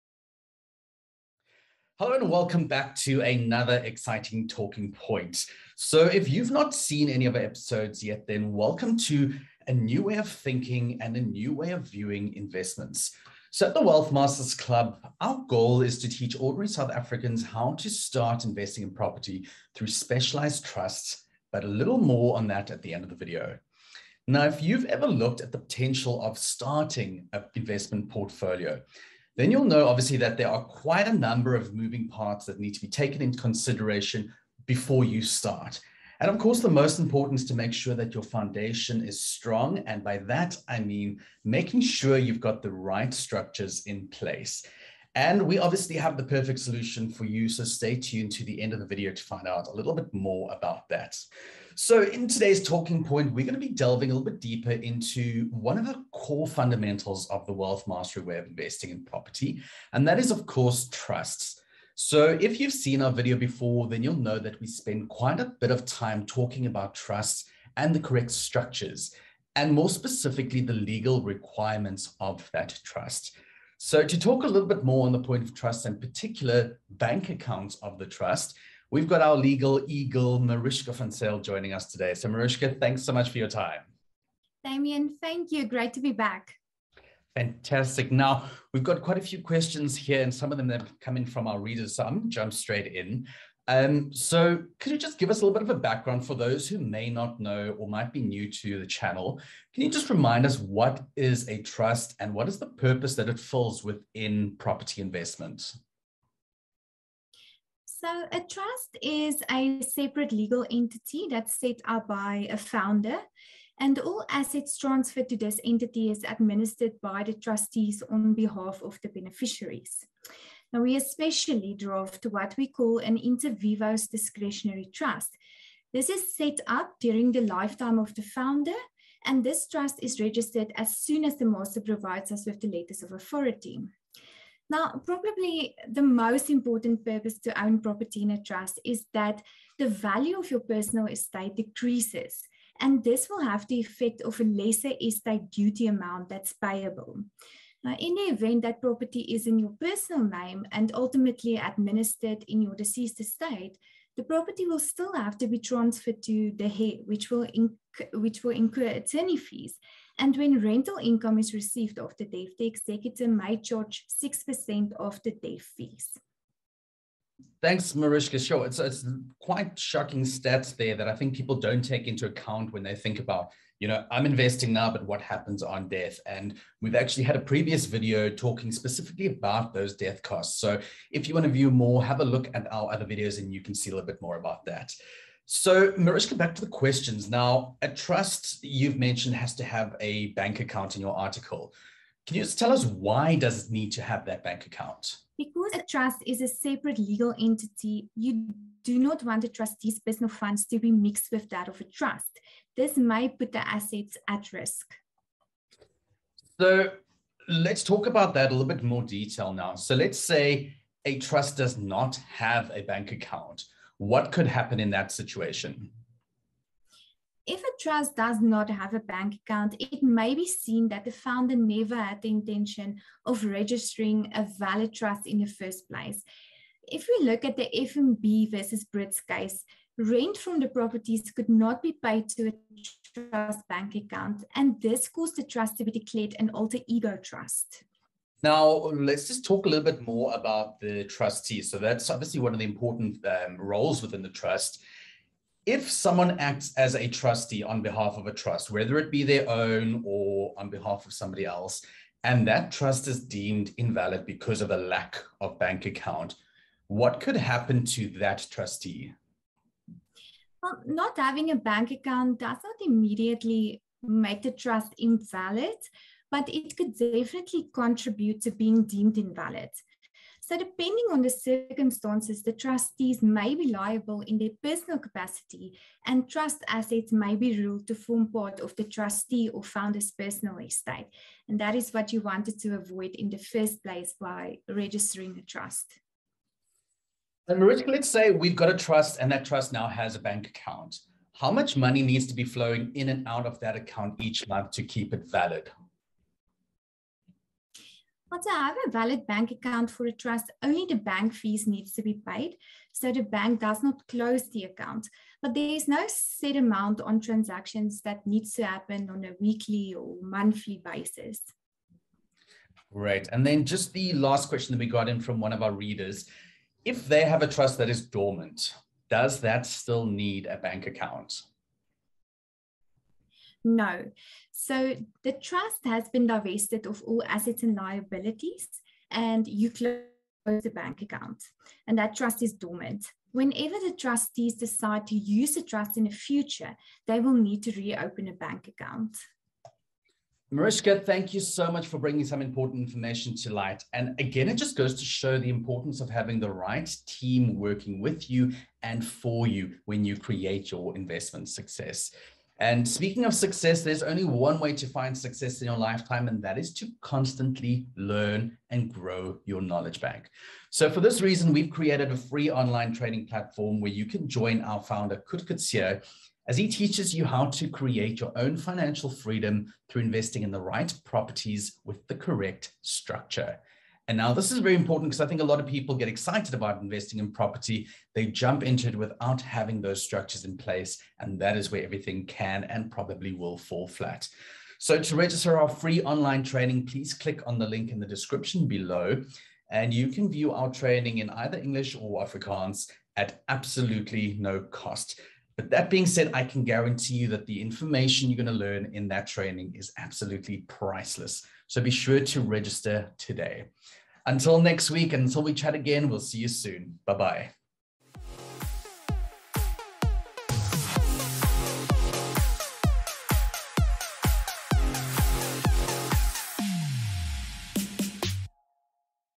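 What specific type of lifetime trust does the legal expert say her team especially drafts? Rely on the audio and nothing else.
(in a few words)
inter vivos discretionary trust.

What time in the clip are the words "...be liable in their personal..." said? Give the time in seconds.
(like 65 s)
273 s.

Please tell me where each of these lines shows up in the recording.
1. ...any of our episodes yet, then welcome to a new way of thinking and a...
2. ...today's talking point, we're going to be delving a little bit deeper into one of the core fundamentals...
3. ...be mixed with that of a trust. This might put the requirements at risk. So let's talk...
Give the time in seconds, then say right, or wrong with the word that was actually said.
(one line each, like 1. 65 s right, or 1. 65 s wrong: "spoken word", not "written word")
1. 7 s right
2. 52 s right
3. 200 s wrong: "assets", not "requirements".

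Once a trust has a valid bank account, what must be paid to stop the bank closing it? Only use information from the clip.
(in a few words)
bank fees.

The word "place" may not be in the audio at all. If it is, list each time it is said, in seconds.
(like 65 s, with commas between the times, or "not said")
44 s, 225 s, 283 s, 380 s.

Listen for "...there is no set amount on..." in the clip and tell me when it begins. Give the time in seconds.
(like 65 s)
305 s.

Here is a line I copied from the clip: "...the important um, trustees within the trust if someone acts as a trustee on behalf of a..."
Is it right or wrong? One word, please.
wrong.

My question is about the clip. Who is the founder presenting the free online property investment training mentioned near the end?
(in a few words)
Coert Coetzee.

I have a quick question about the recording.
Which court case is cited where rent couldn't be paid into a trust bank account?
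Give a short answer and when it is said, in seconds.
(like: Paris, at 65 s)
FNB versus Britz, at 227 s.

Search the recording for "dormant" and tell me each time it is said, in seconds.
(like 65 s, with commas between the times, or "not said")
318 s, 332 s.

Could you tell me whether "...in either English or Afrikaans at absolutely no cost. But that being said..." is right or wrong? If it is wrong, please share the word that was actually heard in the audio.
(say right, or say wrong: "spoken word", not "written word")
right.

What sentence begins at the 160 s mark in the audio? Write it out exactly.
And when rental income is received after death, the executor may charge 6% of the death fees.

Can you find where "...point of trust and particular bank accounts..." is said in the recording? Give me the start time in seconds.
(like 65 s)
75 s.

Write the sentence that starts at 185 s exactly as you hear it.
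So, Marishka, back to the questions.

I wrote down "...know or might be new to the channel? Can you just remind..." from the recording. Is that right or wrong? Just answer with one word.
right.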